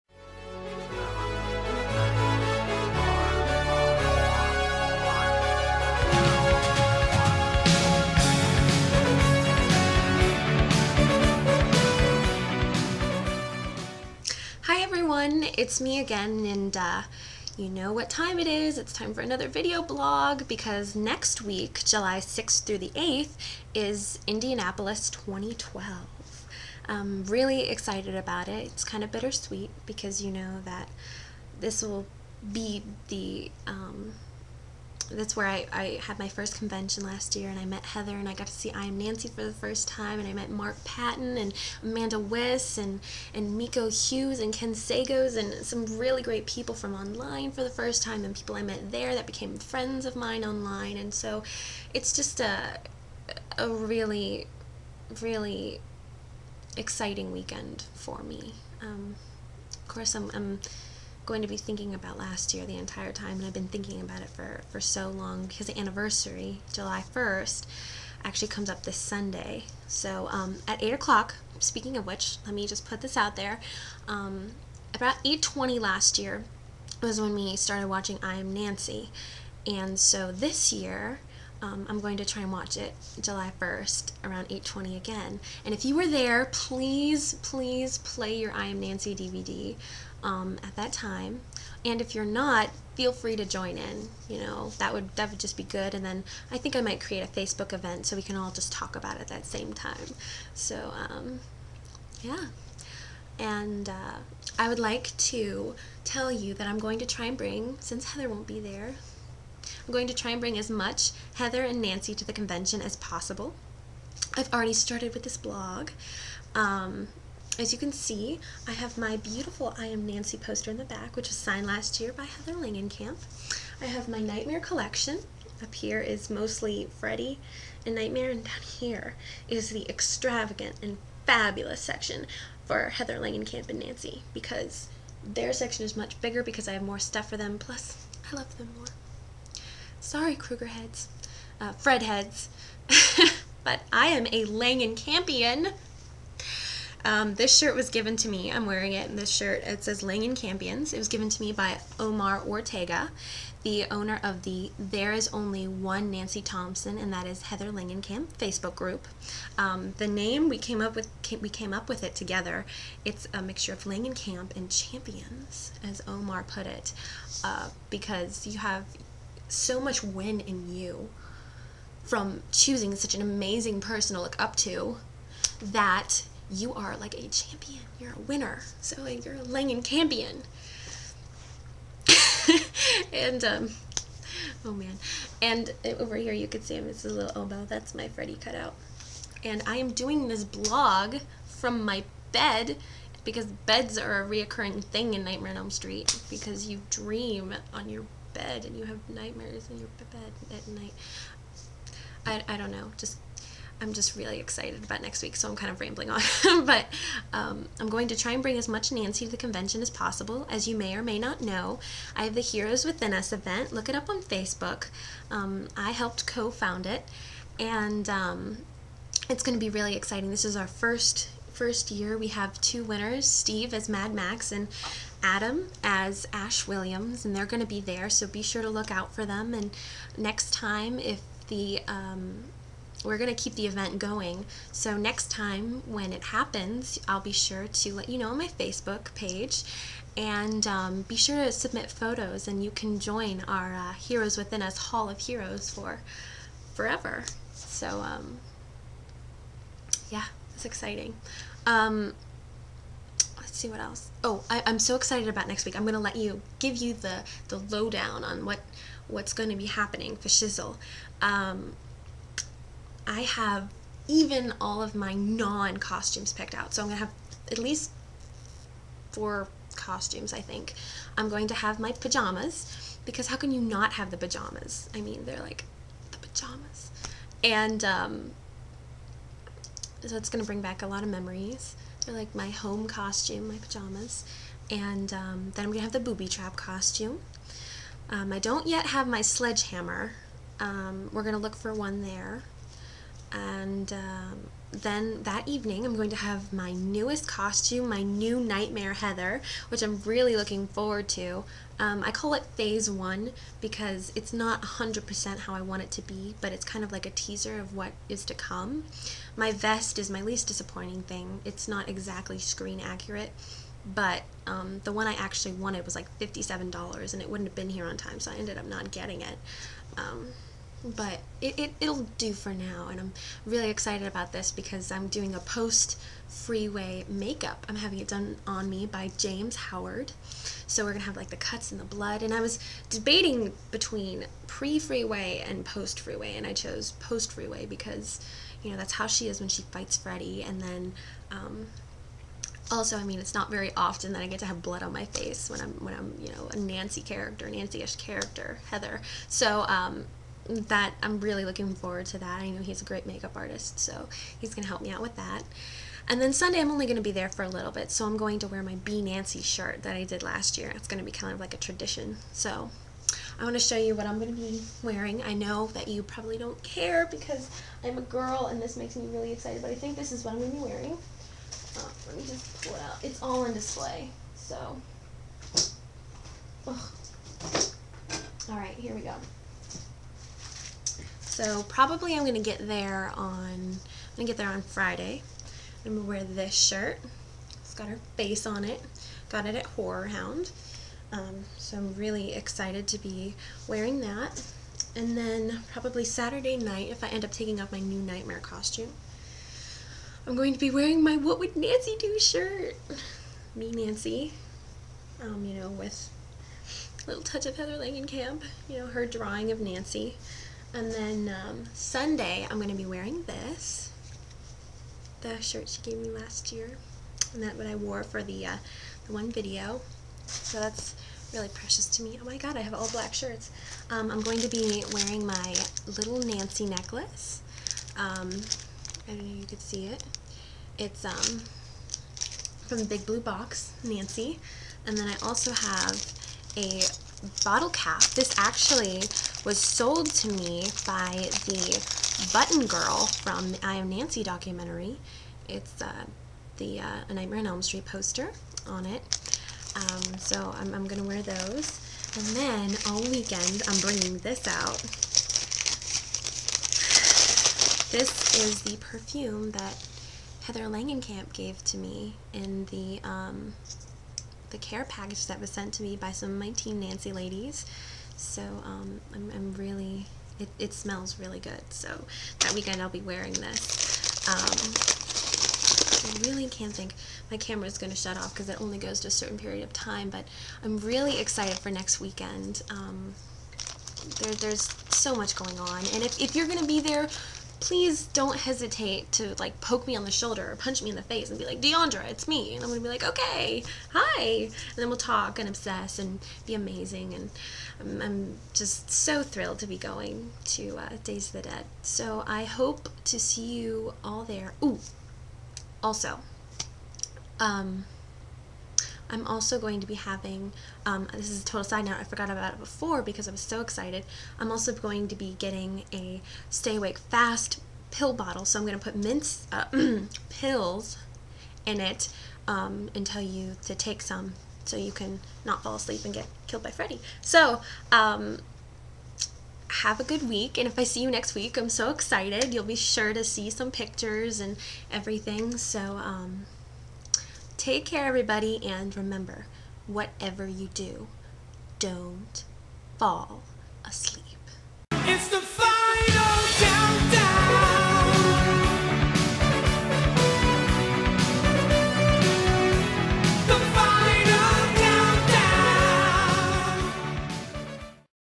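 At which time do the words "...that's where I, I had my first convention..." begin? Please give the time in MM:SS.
00:35.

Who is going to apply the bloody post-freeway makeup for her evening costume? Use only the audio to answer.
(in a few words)
James Howard.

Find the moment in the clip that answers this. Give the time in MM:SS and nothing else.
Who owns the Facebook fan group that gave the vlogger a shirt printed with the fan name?
02:31.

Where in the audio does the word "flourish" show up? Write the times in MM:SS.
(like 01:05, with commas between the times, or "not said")
not said.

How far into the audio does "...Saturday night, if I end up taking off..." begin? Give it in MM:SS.
06:36.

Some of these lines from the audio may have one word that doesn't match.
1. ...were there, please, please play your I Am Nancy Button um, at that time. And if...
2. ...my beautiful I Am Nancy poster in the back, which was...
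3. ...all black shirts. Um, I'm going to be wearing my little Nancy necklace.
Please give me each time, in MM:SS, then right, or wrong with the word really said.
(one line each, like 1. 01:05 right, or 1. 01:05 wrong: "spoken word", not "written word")
1. 01:25 wrong: "DVD", not "Button"
2. 01:58 right
3. 07:02 right.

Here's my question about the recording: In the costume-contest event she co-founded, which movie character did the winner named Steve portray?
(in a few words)
Mad Max.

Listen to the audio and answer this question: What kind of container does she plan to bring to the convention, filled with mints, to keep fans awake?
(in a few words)
stay awake fast pill bottle.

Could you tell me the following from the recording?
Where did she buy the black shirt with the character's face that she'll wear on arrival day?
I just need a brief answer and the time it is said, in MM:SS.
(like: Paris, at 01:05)
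Horror Hound, at 06:29.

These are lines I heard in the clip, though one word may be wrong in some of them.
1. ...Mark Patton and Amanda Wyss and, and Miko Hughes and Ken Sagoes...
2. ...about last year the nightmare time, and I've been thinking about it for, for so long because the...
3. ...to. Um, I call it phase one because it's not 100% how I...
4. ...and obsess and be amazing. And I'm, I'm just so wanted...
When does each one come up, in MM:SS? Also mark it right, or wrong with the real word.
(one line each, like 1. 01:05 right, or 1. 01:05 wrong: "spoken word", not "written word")
1. 00:40 right
2. 01:01 wrong: "entire", not "nightmare"
3. 05:01 right
4. 08:15 wrong: "thrilled", not "wanted".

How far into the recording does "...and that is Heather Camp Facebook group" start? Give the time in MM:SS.
02:36.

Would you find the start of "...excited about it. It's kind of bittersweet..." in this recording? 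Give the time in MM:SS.
00:27.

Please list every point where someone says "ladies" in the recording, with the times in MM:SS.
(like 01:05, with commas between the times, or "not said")
07:47.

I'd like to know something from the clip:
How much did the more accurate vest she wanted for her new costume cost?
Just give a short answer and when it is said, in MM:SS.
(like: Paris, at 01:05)
$57, at 05:16.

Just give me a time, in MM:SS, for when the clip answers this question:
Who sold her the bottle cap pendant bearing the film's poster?
07:22.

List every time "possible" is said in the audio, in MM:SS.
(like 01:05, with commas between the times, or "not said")
01:52, 03:29.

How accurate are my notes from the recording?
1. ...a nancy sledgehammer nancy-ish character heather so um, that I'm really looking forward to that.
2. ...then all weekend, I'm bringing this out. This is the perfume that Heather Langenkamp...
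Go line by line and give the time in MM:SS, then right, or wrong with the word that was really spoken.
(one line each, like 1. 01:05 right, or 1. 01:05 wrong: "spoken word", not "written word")
1. 05:46 wrong: "character", not "sledgehammer"
2. 07:32 right.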